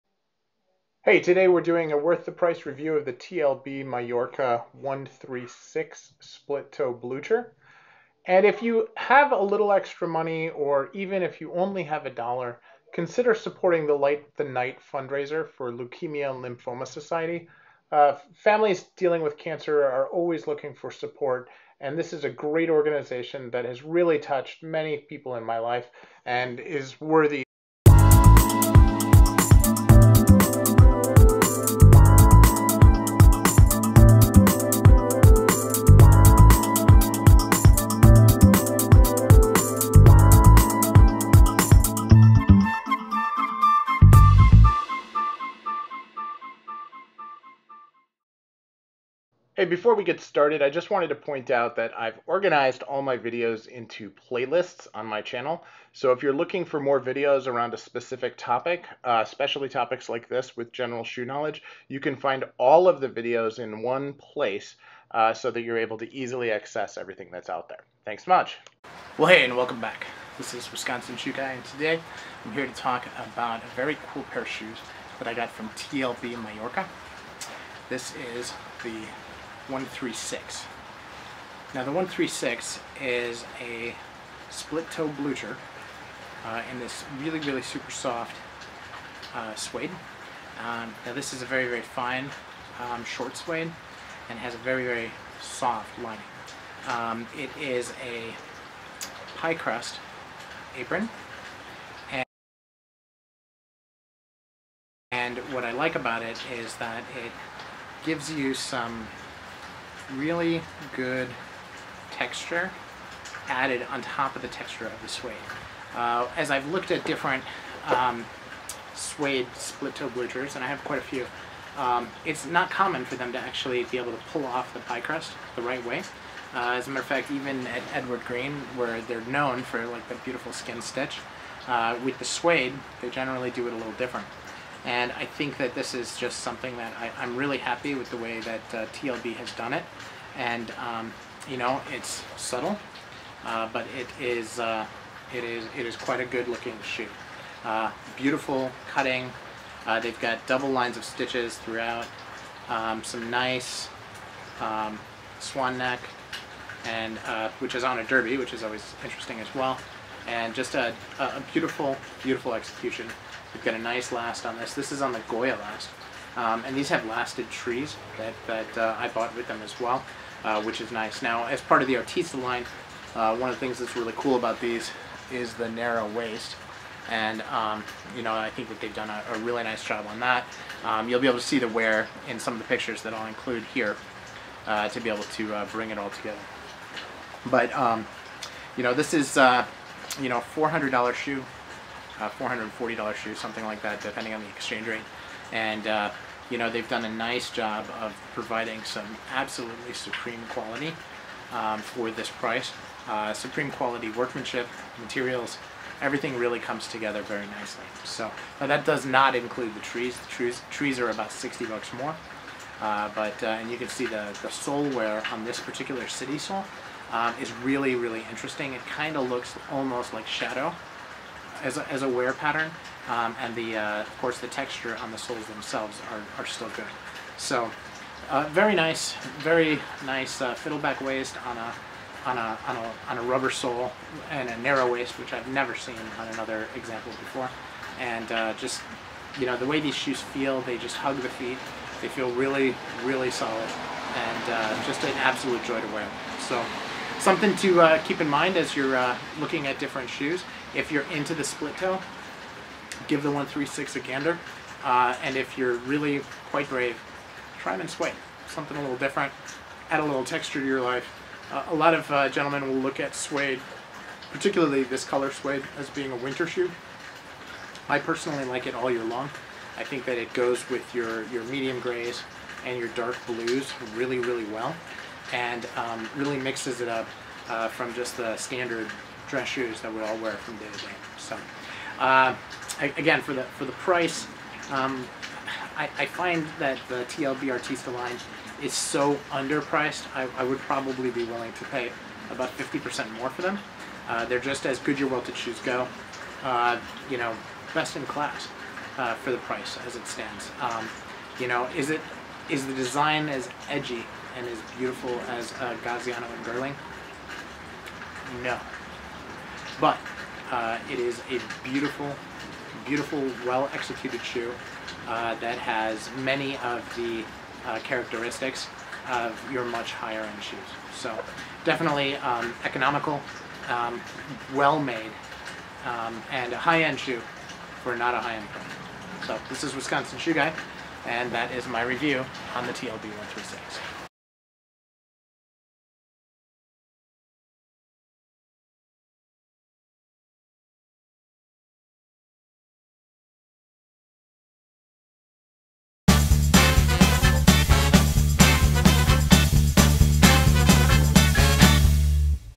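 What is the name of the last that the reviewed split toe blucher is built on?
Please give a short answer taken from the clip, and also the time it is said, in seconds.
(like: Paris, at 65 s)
Goya, at 165 s.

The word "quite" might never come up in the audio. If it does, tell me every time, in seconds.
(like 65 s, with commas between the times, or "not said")
120 s, 145 s, 256 s.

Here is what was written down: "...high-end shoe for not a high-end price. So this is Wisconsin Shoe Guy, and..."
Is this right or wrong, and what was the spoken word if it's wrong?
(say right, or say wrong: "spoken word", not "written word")
right.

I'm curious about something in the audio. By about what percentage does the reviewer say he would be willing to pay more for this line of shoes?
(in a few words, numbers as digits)
50%.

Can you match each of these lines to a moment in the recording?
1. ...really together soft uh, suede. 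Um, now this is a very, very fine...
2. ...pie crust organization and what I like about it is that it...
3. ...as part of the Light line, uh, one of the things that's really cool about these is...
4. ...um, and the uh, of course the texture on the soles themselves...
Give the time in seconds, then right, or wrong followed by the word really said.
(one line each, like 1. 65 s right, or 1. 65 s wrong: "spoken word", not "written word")
1. 87 s wrong: "super", not "together"
2. 99 s wrong: "apron", not "organization"
3. 171 s wrong: "Artista", not "Light"
4. 223 s right.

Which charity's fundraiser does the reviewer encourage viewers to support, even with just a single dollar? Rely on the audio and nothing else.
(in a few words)
Leukemia and Lymphoma Society.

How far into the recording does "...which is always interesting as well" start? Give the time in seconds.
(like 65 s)
158 s.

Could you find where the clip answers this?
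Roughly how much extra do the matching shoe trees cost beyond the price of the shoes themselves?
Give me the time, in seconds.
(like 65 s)
211 s.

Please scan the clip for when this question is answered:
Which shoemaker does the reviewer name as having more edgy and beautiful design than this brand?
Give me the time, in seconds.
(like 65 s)
305 s.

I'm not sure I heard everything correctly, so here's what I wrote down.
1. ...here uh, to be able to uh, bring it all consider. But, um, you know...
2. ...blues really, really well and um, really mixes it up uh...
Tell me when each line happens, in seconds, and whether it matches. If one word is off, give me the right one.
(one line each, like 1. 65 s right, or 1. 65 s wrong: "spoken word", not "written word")
1. 183 s wrong: "together", not "consider"
2. 273 s right.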